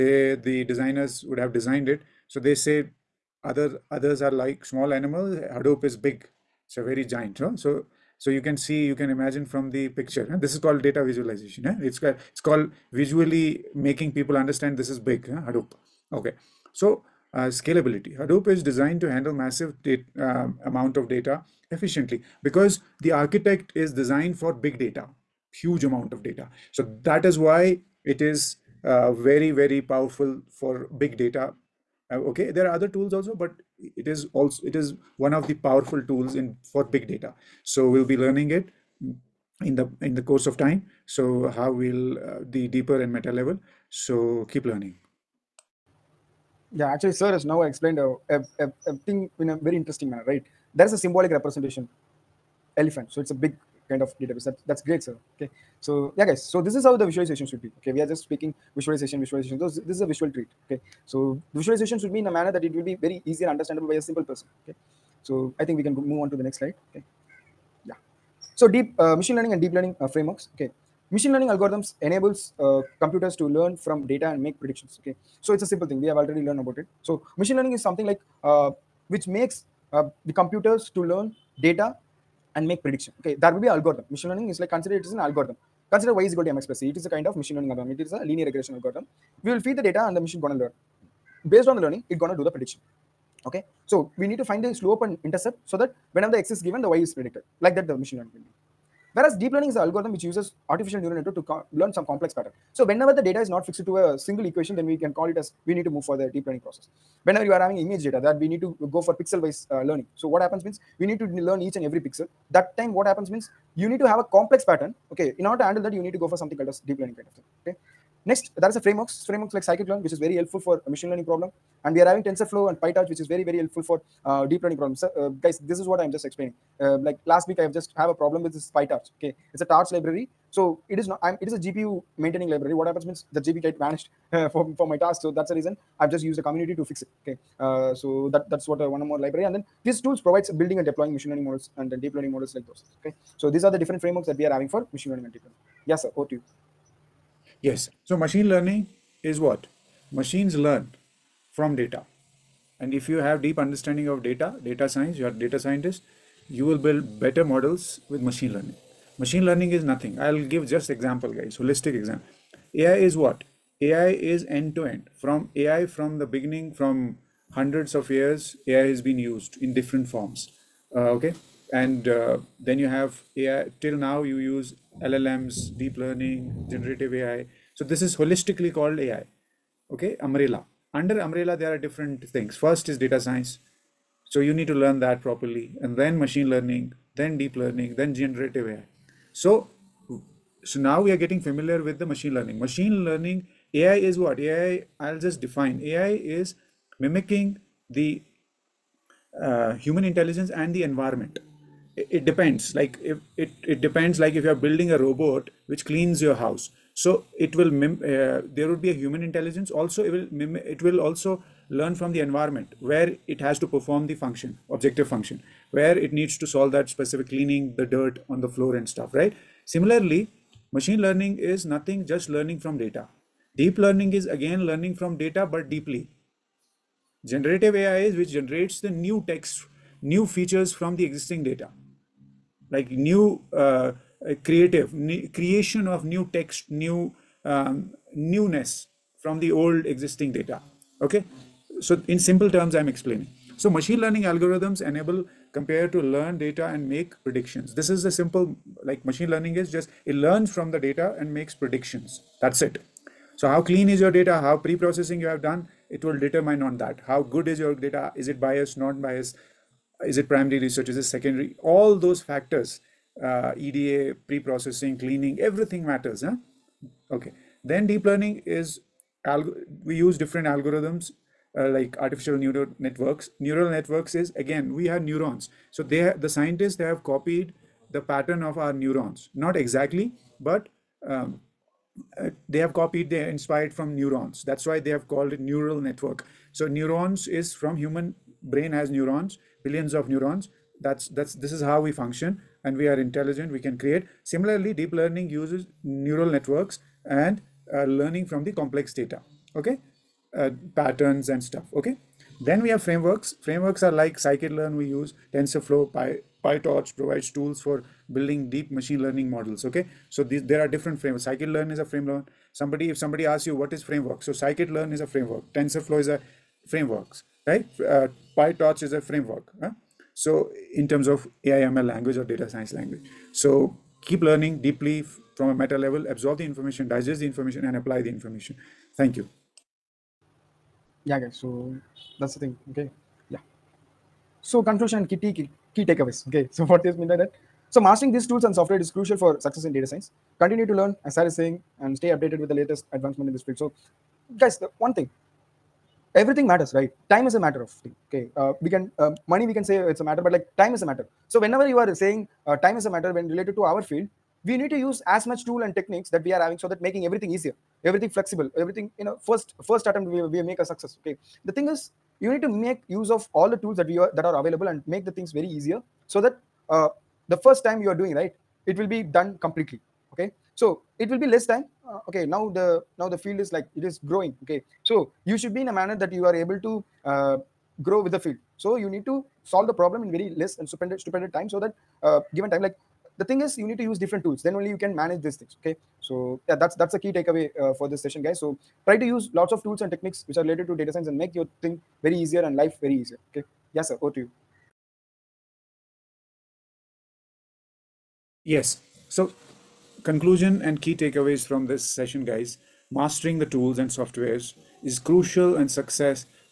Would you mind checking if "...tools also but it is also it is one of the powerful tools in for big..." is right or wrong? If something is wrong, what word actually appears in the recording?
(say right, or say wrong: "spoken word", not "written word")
right.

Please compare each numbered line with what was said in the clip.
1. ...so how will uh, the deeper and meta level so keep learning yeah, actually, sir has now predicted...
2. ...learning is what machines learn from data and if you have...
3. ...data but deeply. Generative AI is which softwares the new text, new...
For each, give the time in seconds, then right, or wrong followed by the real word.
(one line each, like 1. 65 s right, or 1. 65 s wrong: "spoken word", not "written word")
1. 41 s wrong: "explained", not "predicted"
2. 148 s right
3. 225 s wrong: "generates", not "softwares".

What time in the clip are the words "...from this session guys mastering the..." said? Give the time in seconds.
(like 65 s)
401 s.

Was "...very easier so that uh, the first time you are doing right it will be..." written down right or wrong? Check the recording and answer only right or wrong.
right.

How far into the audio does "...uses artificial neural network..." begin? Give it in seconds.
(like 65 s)
100 s.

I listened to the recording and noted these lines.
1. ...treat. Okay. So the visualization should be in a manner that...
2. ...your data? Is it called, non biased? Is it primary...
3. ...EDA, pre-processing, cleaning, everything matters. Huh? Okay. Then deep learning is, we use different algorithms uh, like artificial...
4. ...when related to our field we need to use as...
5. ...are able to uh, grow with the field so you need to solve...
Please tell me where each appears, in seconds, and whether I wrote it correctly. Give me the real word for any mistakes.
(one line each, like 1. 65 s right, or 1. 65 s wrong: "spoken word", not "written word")
1. 60 s right
2. 257 s wrong: "biased", not "called"
3. 263 s right
4. 353 s right
5. 376 s right.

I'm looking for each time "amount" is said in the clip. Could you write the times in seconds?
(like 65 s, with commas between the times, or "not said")
20 s, 25 s.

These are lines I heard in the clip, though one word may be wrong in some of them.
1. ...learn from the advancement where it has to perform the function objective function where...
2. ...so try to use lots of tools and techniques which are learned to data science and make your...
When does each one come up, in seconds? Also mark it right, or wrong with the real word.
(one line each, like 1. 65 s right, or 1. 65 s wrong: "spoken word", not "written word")
1. 211 s wrong: "environment", not "advancement"
2. 388 s wrong: "related", not "learned".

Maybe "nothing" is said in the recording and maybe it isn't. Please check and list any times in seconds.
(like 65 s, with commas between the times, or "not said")
159 s, 221 s.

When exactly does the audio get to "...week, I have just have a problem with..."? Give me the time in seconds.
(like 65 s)
127 s.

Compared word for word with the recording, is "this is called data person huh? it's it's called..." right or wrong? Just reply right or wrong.
wrong.